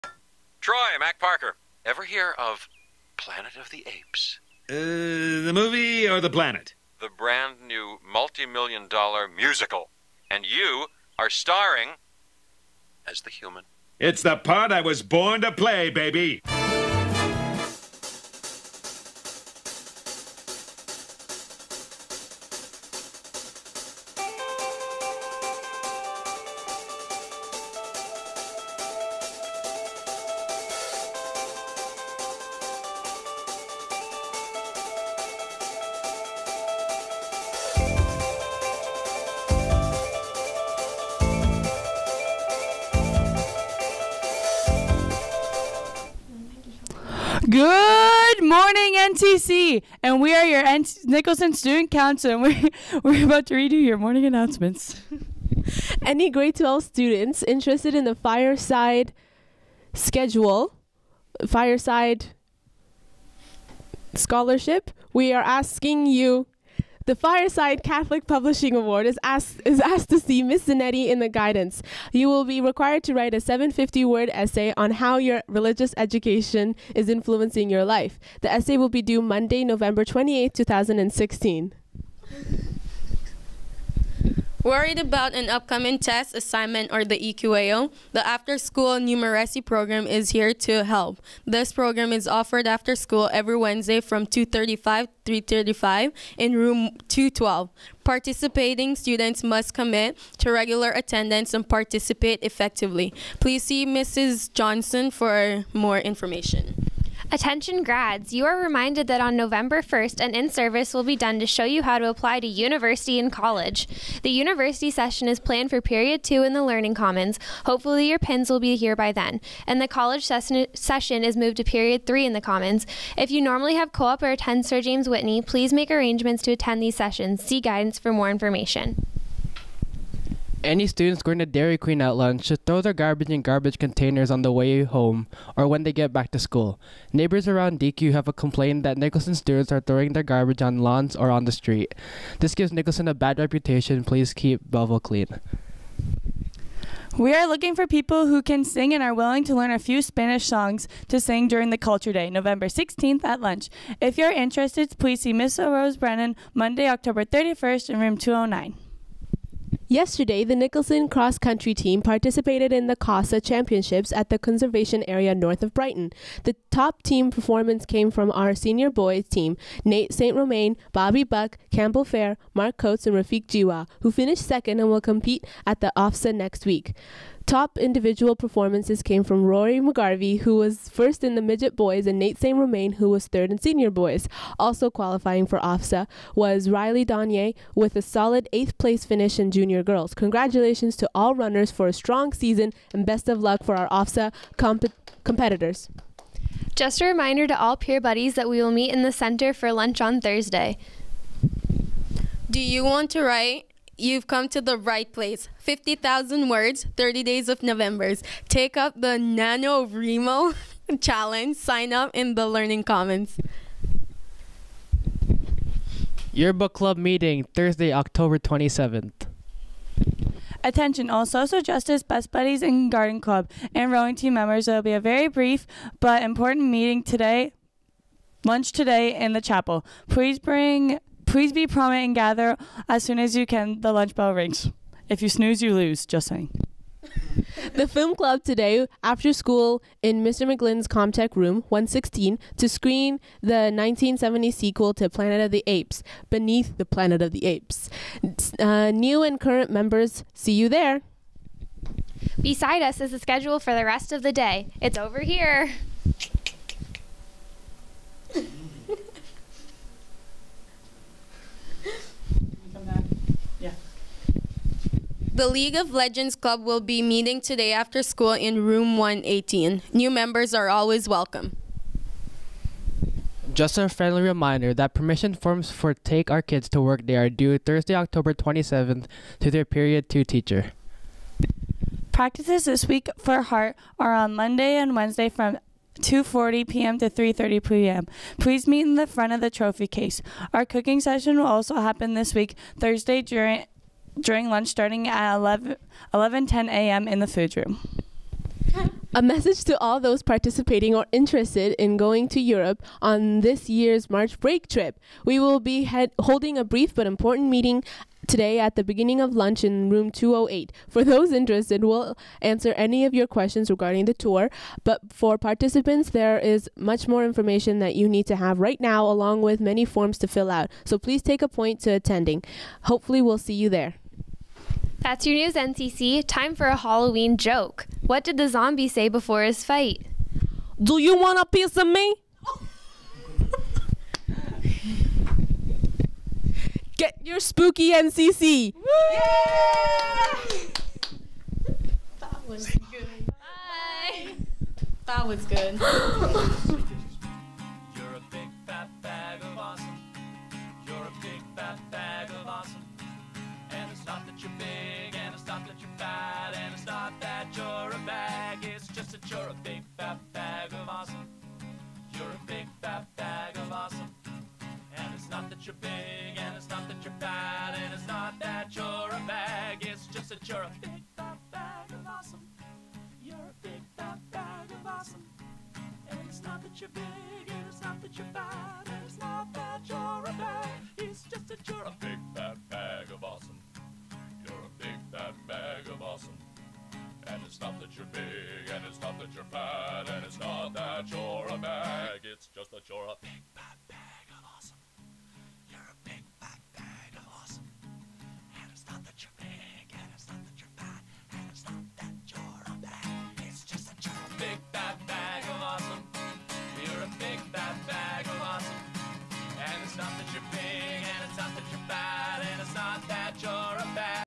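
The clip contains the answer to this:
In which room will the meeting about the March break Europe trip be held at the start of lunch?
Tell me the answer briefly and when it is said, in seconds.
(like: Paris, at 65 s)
208, at 310 s.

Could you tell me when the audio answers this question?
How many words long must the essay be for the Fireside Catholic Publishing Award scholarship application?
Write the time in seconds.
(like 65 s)
73 s.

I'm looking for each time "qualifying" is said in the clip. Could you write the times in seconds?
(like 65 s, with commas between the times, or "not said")
184 s.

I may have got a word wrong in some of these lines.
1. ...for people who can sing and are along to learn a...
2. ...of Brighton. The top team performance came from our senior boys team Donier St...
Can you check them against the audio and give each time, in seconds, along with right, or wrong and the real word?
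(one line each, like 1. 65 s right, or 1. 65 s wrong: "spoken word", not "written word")
1. 147 s wrong: "willing", not "along"
2. 165 s wrong: "Nate", not "Donier".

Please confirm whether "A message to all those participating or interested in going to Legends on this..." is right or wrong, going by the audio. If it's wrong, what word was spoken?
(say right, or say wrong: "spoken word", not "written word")
wrong: "Europe", not "Legends".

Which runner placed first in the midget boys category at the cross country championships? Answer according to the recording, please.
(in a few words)
Rory McGarvey.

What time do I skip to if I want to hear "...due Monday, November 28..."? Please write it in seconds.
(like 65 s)
79 s.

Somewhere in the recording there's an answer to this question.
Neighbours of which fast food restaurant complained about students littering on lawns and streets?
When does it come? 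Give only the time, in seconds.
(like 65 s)
131 s.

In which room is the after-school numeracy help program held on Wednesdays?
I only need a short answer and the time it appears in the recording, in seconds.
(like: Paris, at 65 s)
212, at 97 s.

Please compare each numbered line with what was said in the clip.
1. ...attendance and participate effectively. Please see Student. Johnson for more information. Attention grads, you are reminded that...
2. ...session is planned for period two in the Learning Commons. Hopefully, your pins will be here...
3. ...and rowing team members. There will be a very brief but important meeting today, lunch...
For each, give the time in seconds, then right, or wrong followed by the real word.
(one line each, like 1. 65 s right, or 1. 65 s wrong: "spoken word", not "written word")
1. 100 s wrong: "Mrs", not "Student"
2. 114 s right
3. 223 s right.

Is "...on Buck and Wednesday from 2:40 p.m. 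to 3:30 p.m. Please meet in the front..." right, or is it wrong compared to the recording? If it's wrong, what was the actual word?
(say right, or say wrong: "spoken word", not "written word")
wrong: "Monday", not "Buck".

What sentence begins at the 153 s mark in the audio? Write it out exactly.
If you're interested, please see Miss Rose Brennan Monday, October 31st in room 209.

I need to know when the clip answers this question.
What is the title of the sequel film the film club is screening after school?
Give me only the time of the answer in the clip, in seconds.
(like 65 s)
246 s.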